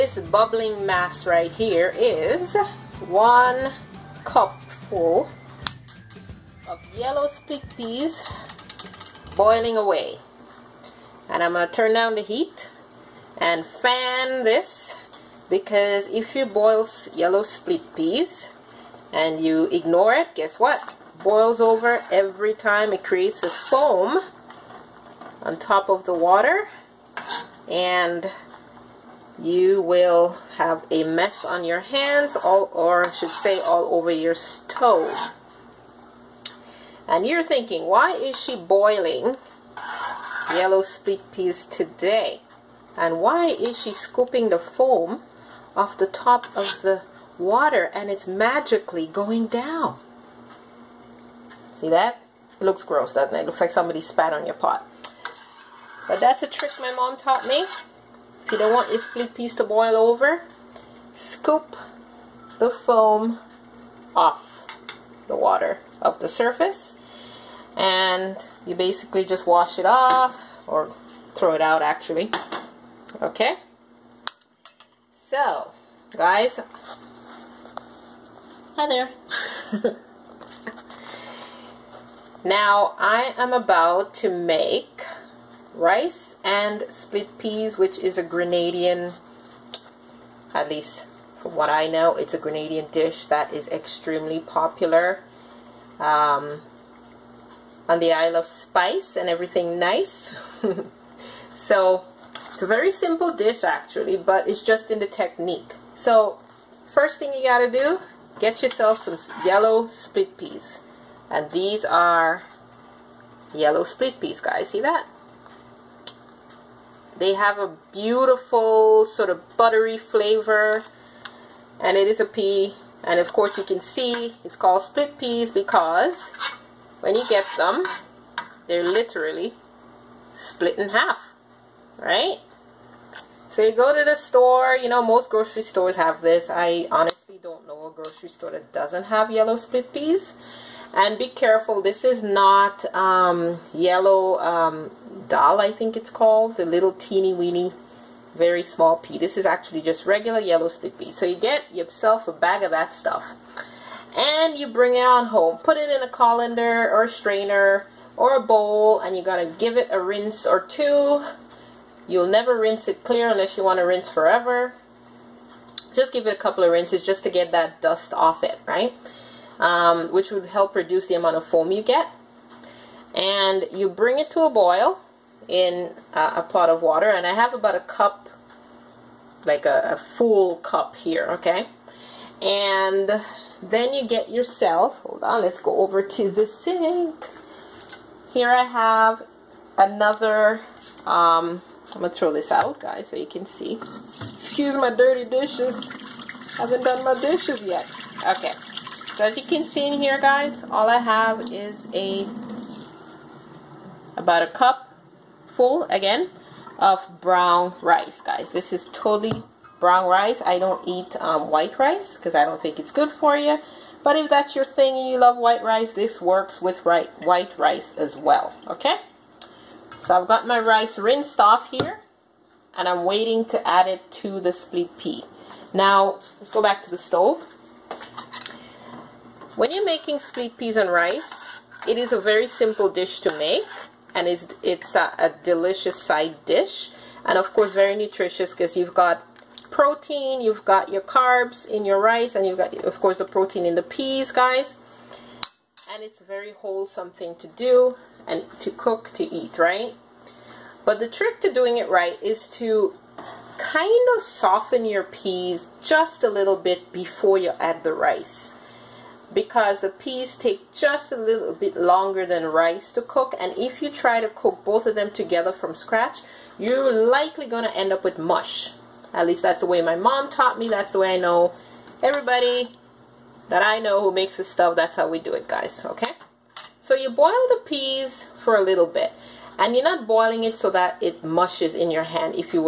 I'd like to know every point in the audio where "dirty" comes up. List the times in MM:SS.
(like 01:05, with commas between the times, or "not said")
03:14.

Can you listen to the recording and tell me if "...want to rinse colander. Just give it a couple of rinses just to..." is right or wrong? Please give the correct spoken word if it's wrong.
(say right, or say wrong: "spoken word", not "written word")
wrong: "forever", not "colander".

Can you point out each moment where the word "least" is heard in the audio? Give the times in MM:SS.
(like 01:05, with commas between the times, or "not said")
01:30, 04:29.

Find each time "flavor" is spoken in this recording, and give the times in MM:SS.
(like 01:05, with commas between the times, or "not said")
01:59.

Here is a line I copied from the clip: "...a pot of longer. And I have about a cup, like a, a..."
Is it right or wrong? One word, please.
wrong.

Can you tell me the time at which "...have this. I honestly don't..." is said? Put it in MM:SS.
02:15.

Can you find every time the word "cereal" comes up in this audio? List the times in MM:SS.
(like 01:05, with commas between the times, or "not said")
not said.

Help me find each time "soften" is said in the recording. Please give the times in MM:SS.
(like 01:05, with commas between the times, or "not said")
04:14.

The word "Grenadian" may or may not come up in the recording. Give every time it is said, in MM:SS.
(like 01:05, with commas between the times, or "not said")
01:28, 01:32.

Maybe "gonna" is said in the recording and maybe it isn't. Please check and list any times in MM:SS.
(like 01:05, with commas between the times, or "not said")
03:12.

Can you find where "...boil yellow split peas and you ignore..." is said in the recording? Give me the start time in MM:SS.
00:16.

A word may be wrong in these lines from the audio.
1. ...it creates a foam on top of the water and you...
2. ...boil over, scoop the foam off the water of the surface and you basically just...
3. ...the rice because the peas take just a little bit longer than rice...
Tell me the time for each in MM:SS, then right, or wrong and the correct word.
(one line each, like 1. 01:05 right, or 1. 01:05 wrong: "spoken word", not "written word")
1. 00:22 right
2. 00:59 right
3. 04:17 right.